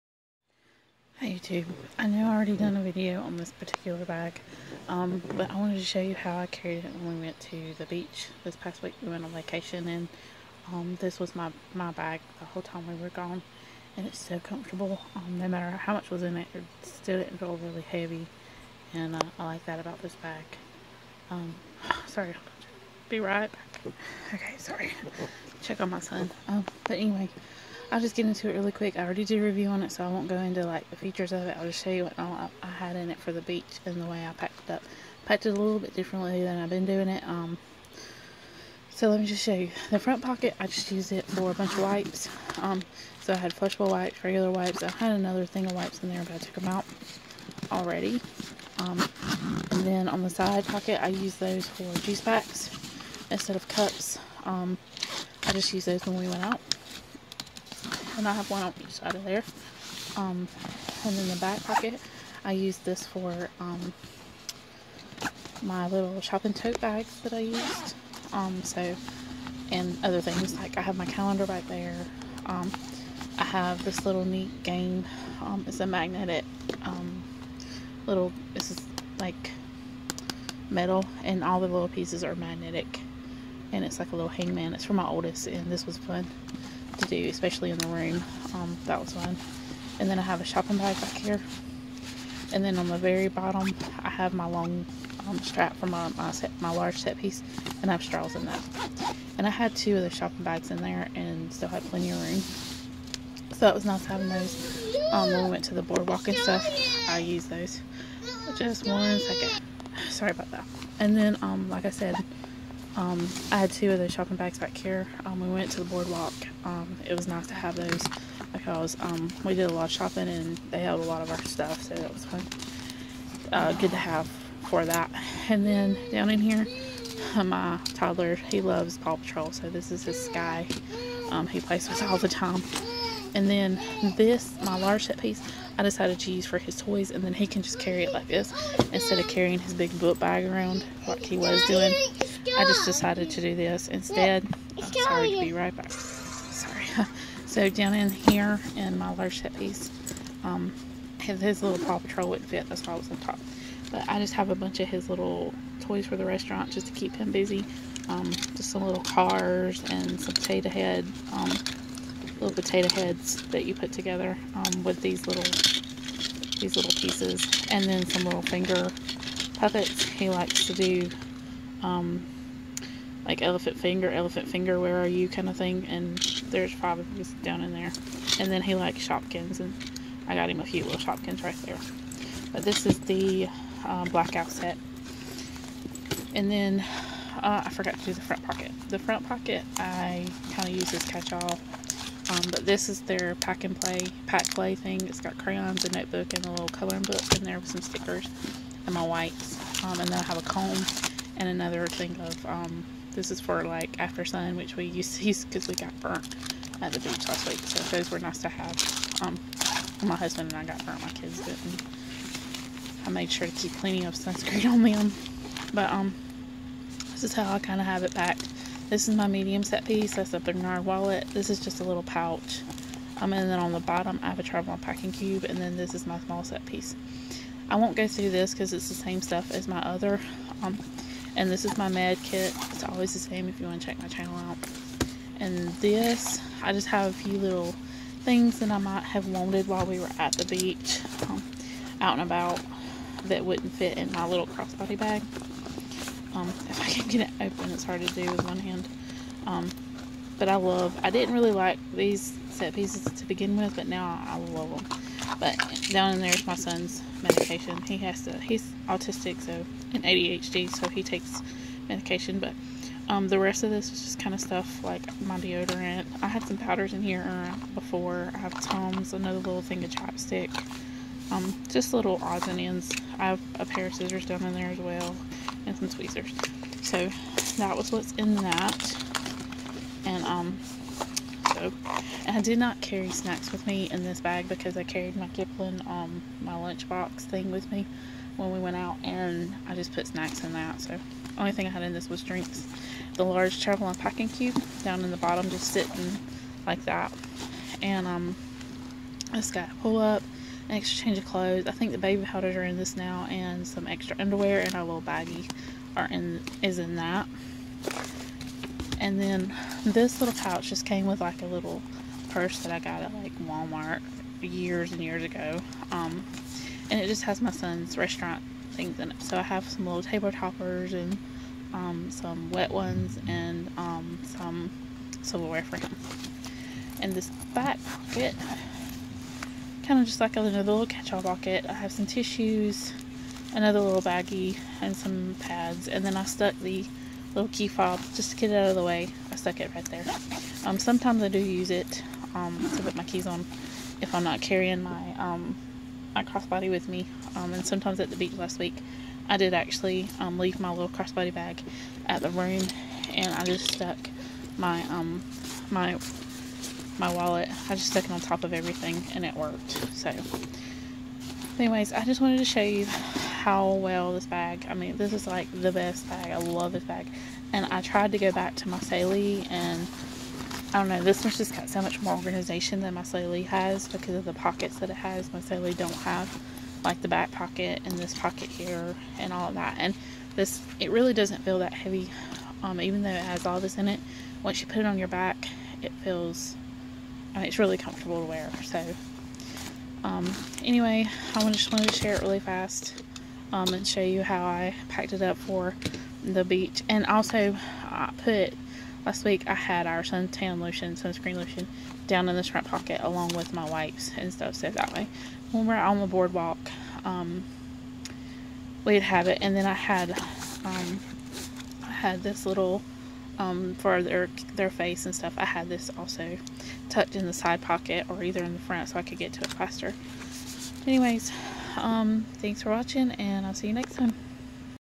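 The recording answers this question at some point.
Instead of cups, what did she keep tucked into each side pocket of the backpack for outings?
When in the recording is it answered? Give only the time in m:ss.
0:51.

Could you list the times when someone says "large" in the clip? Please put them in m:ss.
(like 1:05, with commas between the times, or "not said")
1:36, 2:14, 2:29, 4:53.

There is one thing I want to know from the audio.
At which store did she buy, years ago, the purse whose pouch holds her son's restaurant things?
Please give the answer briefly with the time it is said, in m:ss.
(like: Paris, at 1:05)
Walmart, at 5:13.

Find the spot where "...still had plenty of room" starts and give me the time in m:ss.
1:41.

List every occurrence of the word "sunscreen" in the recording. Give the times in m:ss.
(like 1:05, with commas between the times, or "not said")
3:34, 6:40.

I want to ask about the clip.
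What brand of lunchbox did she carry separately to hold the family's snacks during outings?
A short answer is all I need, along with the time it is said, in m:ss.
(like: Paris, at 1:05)
Kipling, at 4:45.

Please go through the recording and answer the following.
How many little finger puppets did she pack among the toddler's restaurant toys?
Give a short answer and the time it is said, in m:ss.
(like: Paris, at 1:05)
5, at 2:56.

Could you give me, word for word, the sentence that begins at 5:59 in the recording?
So, anyways, I just wanted to show you how well this bag, I mean, this is like the best bag.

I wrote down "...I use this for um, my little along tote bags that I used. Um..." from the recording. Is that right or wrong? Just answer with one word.
wrong.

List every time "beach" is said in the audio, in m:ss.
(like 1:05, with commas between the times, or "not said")
0:07, 0:33, 3:27, 4:00, 5:48, 6:36.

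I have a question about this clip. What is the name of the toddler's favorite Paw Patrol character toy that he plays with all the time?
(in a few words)
Sky.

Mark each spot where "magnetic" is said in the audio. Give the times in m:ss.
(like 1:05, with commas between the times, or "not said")
1:15, 1:22.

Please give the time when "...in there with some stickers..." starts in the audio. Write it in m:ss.
3:17.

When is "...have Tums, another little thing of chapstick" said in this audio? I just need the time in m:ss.
4:28.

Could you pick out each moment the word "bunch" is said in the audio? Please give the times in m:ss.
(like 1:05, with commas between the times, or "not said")
0:41, 2:34.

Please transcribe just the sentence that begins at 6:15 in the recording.
My Saley don't have like the back pocket and this pocket here and all of that.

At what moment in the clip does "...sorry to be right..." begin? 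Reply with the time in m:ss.
2:25.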